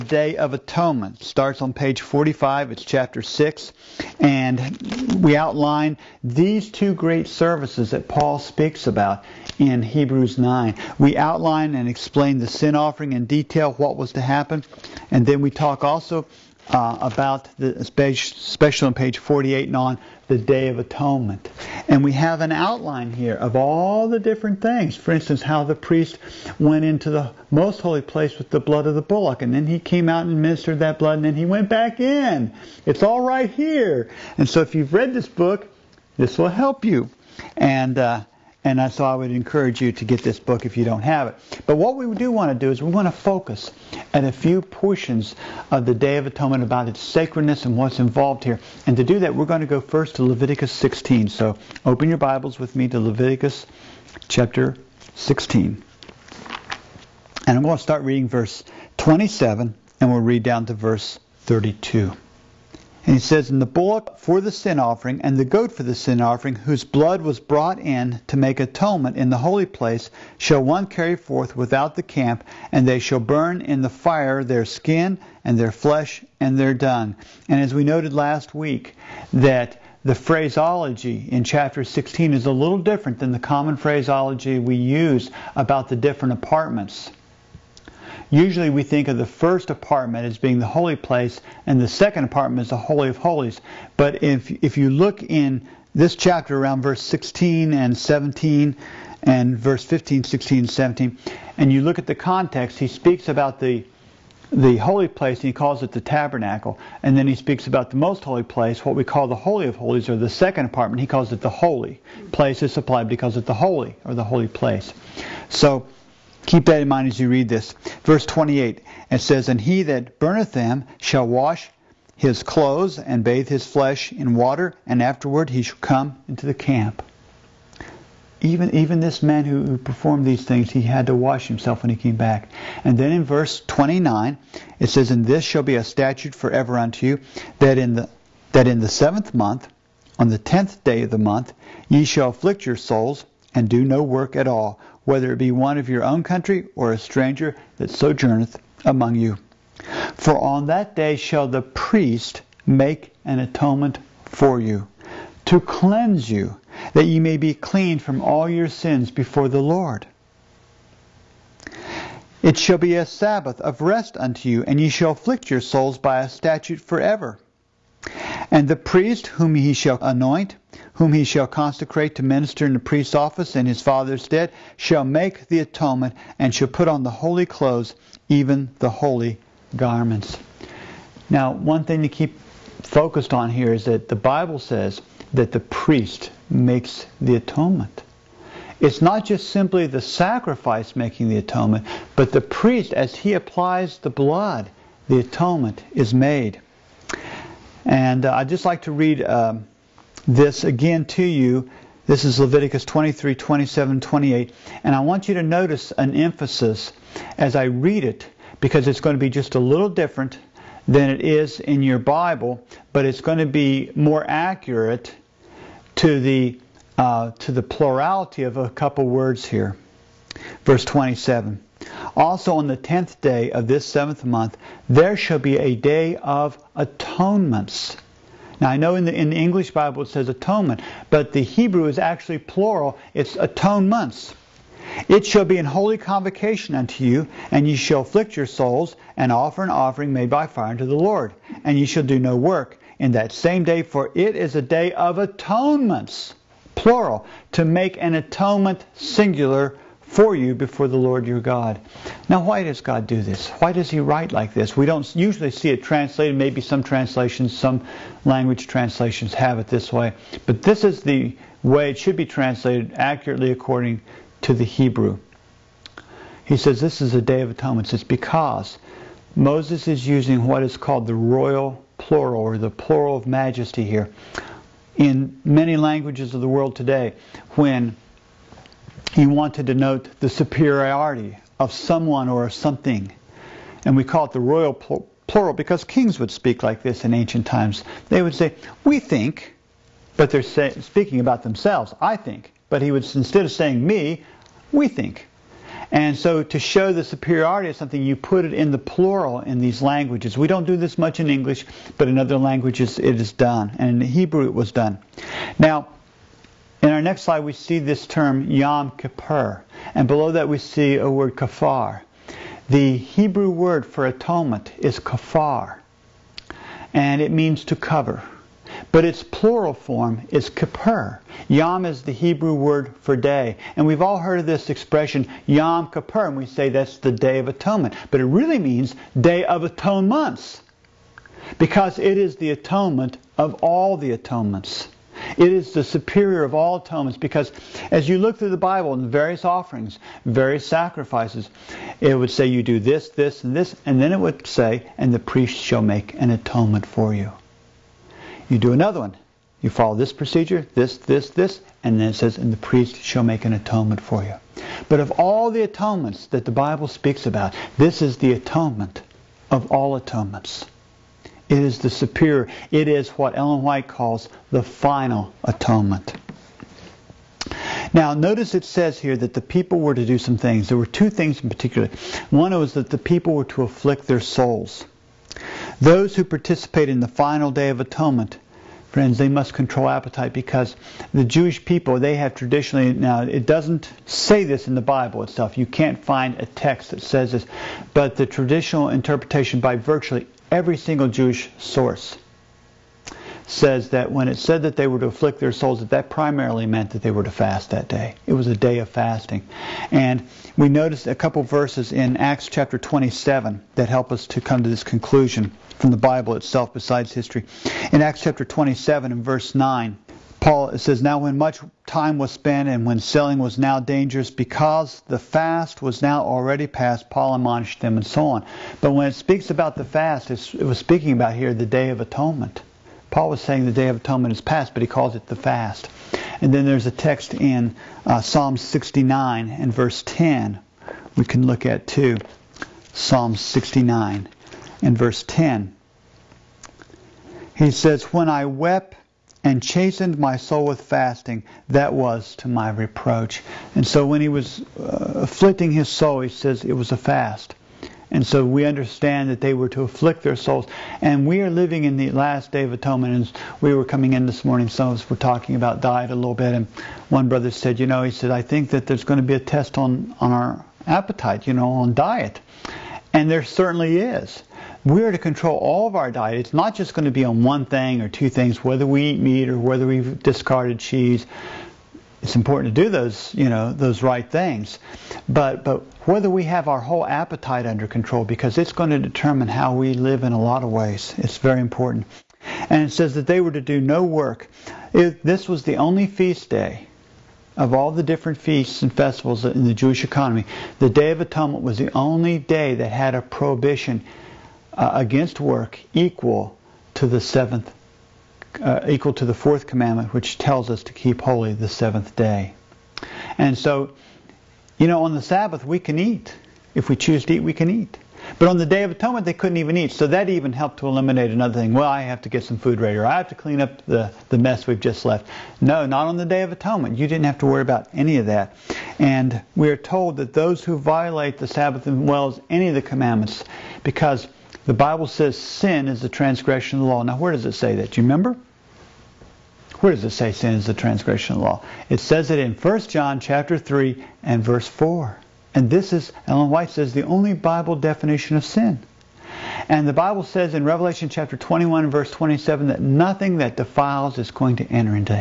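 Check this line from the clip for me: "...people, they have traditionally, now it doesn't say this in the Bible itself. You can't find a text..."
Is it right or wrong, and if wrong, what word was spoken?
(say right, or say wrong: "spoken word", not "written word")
right.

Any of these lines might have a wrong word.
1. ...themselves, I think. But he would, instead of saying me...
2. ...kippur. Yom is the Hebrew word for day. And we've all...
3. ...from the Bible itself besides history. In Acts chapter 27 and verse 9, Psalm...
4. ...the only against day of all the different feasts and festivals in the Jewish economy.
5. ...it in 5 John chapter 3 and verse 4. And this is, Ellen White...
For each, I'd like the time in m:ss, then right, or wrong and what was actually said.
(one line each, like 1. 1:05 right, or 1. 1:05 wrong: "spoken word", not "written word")
1. 4:51 right
2. 5:20 right
3. 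6:45 wrong: "Paul", not "Psalm"
4. 8:05 wrong: "feast", not "against"
5. 8:52 wrong: "1", not "5".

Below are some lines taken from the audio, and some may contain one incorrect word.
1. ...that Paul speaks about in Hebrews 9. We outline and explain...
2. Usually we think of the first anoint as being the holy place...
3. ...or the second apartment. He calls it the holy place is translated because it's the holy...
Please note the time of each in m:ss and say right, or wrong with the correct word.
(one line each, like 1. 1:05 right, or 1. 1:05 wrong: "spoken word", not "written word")
1. 0:07 right
2. 1:28 wrong: "apartment", not "anoint"
3. 1:50 wrong: "supplied", not "translated".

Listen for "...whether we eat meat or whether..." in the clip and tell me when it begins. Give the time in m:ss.
7:48.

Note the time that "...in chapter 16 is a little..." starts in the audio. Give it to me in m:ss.
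1:21.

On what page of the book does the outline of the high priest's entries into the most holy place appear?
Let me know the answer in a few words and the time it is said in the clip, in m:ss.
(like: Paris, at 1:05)
48, at 0:18.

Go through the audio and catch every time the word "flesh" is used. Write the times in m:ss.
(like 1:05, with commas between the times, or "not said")
1:15, 2:03.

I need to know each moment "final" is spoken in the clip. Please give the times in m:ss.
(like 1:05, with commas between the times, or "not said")
6:04, 6:17.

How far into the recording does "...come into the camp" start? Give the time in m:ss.
2:05.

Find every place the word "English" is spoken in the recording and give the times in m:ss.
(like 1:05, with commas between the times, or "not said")
3:49, 5:01.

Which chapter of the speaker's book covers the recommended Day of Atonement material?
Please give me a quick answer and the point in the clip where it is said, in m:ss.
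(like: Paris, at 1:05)
Chapter 6, at 0:02.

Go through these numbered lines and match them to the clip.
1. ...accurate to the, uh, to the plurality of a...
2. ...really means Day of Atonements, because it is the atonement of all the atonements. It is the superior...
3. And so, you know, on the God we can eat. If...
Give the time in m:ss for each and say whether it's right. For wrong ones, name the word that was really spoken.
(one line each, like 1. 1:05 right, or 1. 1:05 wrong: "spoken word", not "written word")
1. 3:34 right
2. 5:28 right
3. 8:23 wrong: "Sabbath", not "God".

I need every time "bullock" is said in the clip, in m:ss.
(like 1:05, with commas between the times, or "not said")
0:29, 1:03.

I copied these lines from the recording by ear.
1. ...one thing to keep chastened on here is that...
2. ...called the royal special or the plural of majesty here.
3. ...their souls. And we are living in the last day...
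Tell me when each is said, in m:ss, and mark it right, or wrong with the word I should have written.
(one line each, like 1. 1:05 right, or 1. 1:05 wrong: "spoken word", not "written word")
1. 3:01 wrong: "focused", not "chastened"
2. 4:30 wrong: "plural", not "special"
3. 7:30 right.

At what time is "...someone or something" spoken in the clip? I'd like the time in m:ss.
4:41.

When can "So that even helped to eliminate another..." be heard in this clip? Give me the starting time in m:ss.
8:29.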